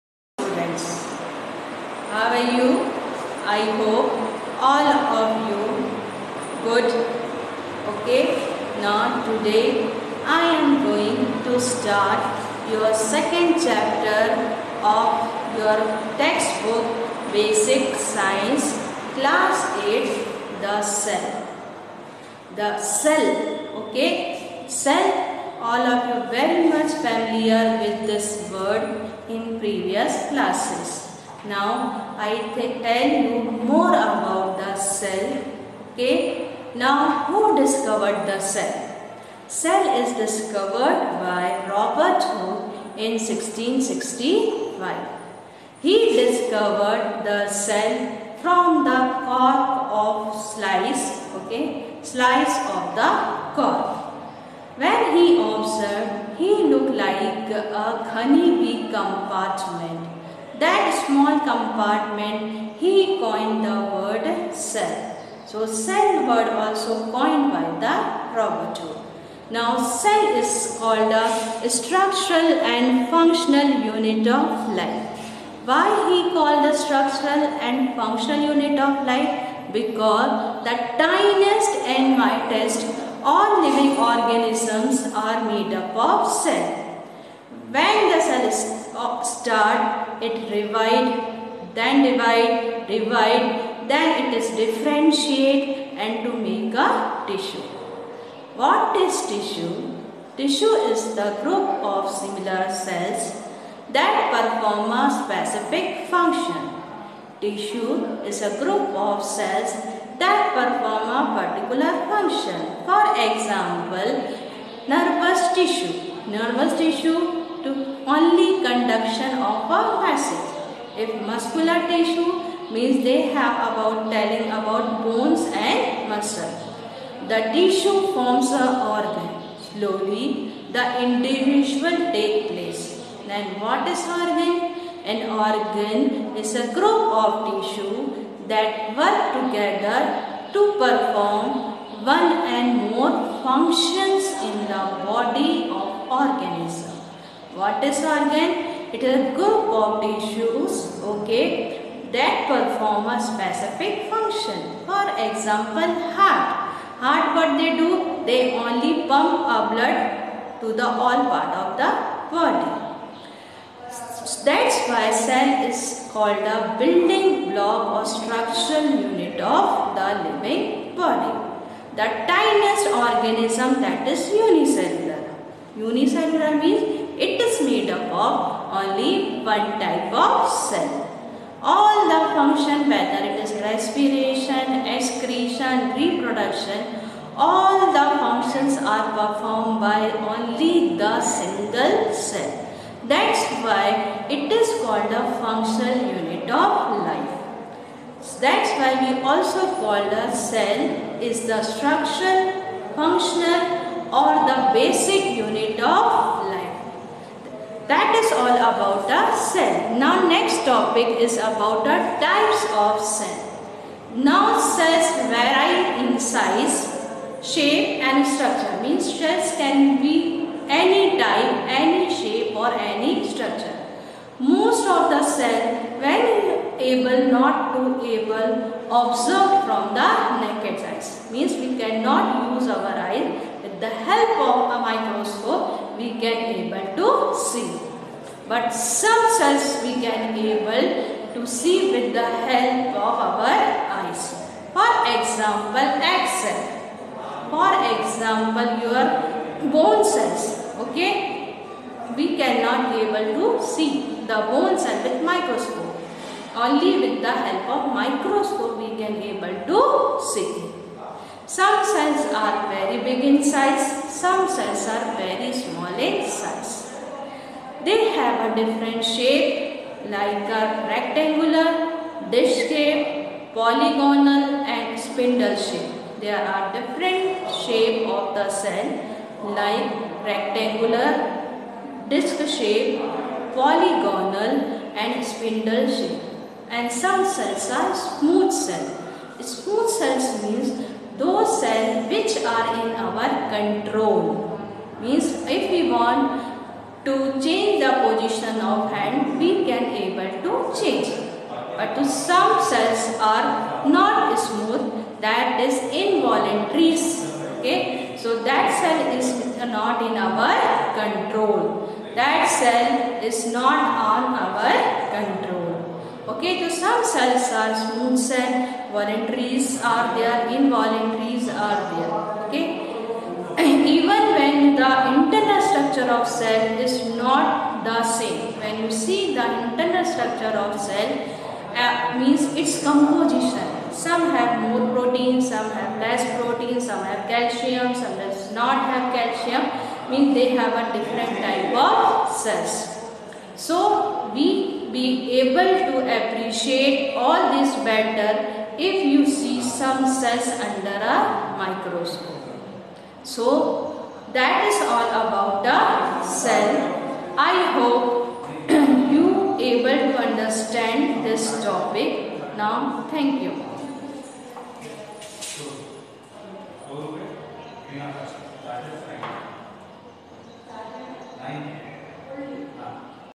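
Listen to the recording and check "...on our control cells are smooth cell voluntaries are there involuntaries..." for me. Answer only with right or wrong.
right.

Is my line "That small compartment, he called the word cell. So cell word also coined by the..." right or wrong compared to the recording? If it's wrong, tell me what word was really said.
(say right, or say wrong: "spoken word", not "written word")
wrong: "coined", not "called".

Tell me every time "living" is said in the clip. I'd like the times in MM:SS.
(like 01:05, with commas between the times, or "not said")
01:23, 02:50.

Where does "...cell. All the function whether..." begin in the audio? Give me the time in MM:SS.
03:00.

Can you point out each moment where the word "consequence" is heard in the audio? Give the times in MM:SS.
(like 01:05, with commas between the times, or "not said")
not said.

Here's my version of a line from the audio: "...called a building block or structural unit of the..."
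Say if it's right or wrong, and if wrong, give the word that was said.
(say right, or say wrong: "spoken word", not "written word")
right.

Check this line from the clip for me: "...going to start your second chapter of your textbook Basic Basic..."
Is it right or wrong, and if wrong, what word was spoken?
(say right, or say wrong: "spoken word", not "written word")
wrong: "Science", not "Basic".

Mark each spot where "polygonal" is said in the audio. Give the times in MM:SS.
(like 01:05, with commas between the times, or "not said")
04:33, 04:43.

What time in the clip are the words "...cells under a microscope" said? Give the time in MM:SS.
05:50.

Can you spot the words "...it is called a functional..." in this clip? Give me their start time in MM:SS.
03:14.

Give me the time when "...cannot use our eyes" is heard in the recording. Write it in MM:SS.
03:51.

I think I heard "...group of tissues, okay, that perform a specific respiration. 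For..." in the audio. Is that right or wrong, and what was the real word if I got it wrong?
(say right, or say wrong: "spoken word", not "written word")
wrong: "function", not "respiration".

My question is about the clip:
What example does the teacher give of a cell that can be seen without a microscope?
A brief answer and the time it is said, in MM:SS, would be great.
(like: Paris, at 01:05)
Egg cell, at 04:06.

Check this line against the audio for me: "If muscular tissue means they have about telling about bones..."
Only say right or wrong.
right.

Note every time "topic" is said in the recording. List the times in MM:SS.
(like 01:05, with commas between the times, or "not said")
03:30, 06:01.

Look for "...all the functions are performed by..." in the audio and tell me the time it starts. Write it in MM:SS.
03:07.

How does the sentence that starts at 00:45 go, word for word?
He discovered the cell from the cork of slice, okay, slice of the cork.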